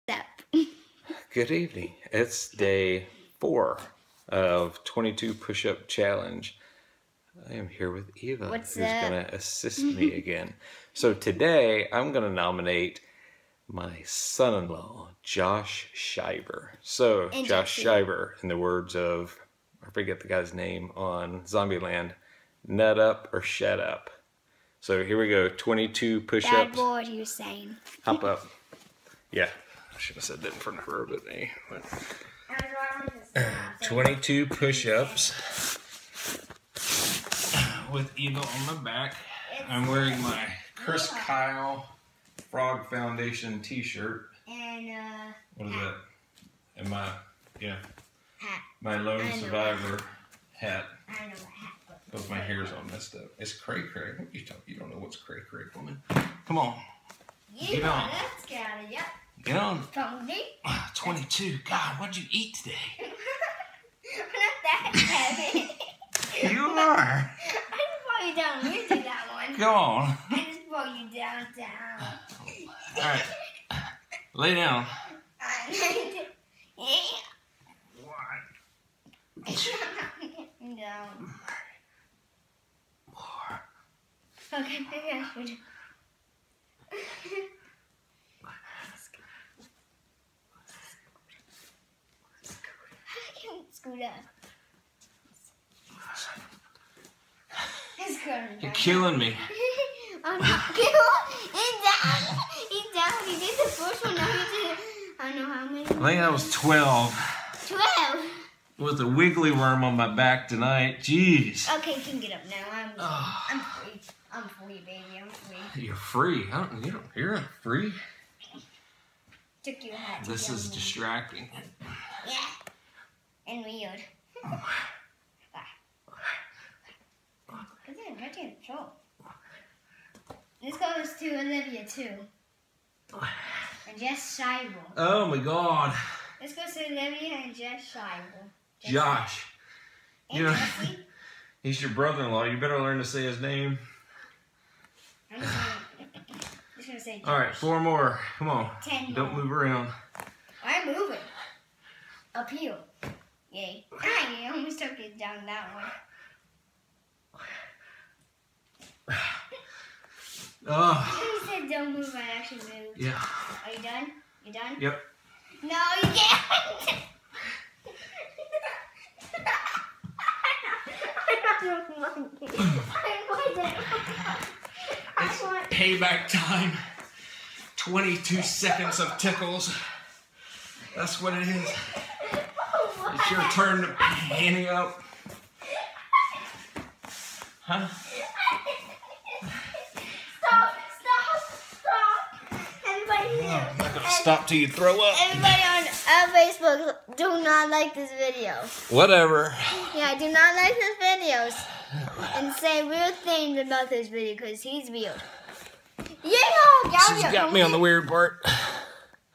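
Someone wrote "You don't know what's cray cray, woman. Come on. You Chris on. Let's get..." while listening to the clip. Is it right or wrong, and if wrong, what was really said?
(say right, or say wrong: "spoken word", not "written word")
wrong: "Get", not "Chris".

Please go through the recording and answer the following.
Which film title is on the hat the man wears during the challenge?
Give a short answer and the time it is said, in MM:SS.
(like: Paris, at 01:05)
Lone Survivor, at 00:48.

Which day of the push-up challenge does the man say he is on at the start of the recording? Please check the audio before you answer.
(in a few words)
4.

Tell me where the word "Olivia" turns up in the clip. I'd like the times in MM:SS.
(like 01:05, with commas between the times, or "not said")
02:11, 02:16.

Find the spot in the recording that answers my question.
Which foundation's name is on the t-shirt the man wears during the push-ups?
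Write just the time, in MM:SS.
00:40.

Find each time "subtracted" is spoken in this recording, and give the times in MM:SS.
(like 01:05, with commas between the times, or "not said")
not said.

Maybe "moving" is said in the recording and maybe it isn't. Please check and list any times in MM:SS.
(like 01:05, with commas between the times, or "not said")
02:30.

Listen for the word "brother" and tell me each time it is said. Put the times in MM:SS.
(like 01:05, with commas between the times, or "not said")
02:21.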